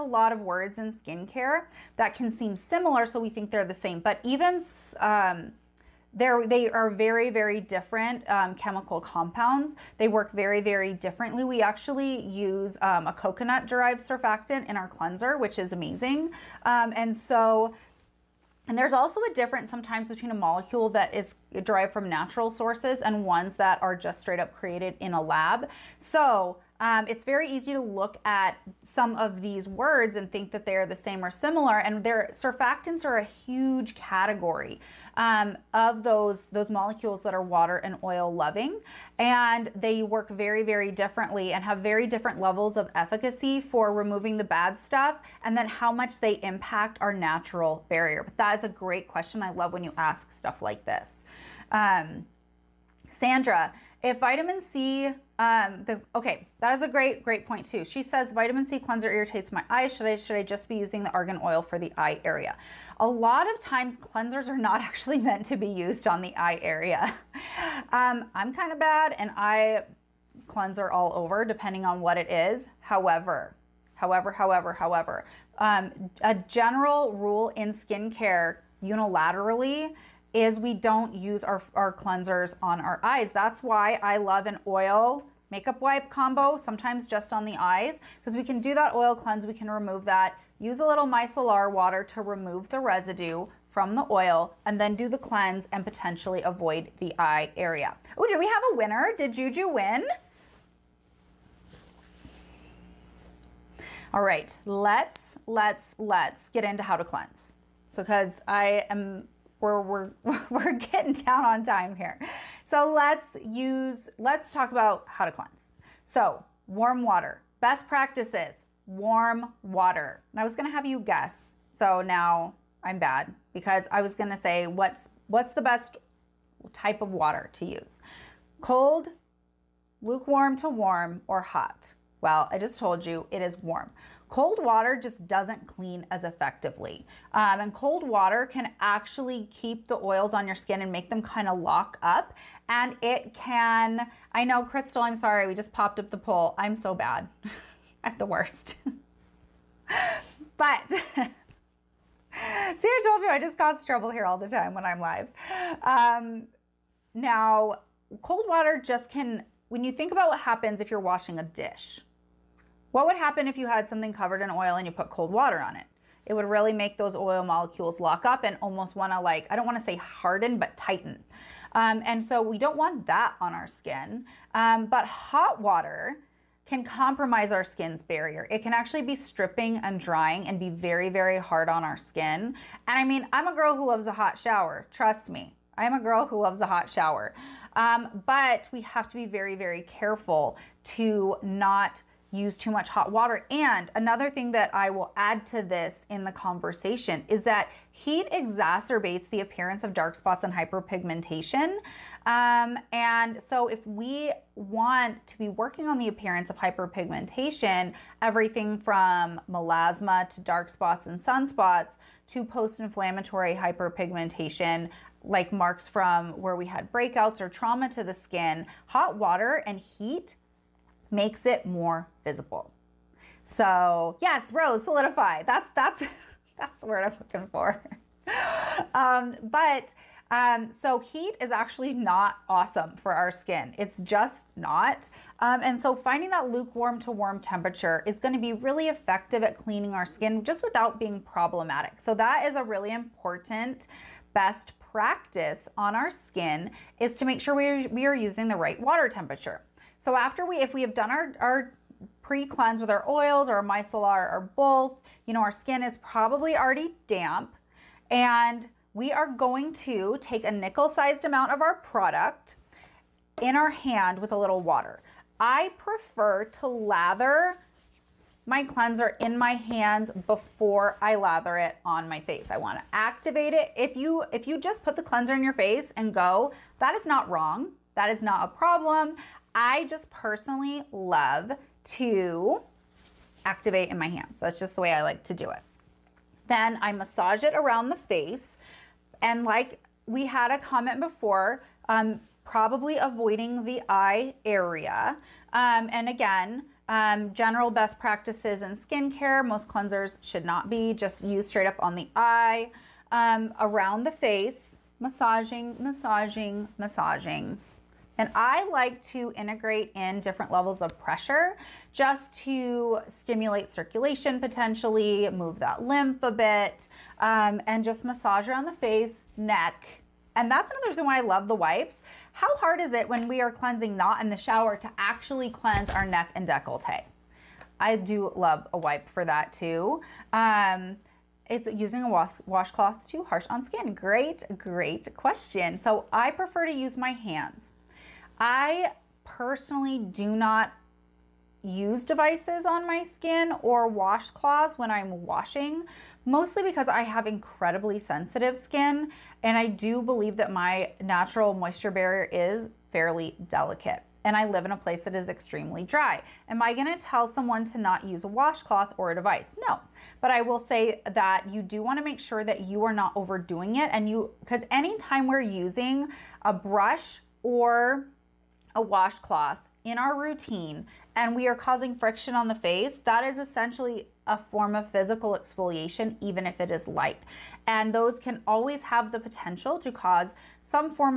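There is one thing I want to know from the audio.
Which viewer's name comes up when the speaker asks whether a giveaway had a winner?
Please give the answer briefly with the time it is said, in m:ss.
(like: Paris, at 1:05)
Juju, at 1:39.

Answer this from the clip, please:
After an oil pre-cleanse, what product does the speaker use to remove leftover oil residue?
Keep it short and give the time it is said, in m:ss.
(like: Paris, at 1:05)
micellar water, at 1:31.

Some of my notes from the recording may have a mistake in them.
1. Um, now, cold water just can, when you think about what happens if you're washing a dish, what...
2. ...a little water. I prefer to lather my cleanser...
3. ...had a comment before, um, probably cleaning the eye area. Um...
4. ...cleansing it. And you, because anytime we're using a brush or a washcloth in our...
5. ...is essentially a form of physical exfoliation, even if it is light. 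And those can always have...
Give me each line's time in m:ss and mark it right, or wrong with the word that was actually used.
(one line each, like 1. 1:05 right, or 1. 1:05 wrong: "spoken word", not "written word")
1. 2:35 right
2. 4:24 right
3. 4:50 wrong: "avoiding", not "cleaning"
4. 6:03 wrong: "overdoing", not "cleansing"
5. 6:13 right.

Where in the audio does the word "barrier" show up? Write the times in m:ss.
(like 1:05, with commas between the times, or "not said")
0:47, 2:58, 5:51.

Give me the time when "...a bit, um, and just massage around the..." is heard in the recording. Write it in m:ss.
5:16.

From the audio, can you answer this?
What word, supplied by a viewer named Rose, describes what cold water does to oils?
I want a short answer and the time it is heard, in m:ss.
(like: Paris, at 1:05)
solidify, at 3:44.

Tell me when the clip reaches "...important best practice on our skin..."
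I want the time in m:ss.
4:02.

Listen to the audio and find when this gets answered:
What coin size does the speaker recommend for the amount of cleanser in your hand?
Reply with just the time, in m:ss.
4:20.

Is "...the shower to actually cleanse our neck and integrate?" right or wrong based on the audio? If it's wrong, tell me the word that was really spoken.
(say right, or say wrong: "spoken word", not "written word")
wrong: "decollete", not "integrate".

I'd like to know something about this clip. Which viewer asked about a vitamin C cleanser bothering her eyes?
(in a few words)
Sandra.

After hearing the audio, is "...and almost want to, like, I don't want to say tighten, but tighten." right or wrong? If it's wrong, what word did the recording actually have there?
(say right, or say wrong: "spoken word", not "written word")
wrong: "harden", not "tighten".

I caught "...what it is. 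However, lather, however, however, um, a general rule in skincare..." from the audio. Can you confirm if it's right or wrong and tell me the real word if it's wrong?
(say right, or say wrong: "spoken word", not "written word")
wrong: "however", not "lather".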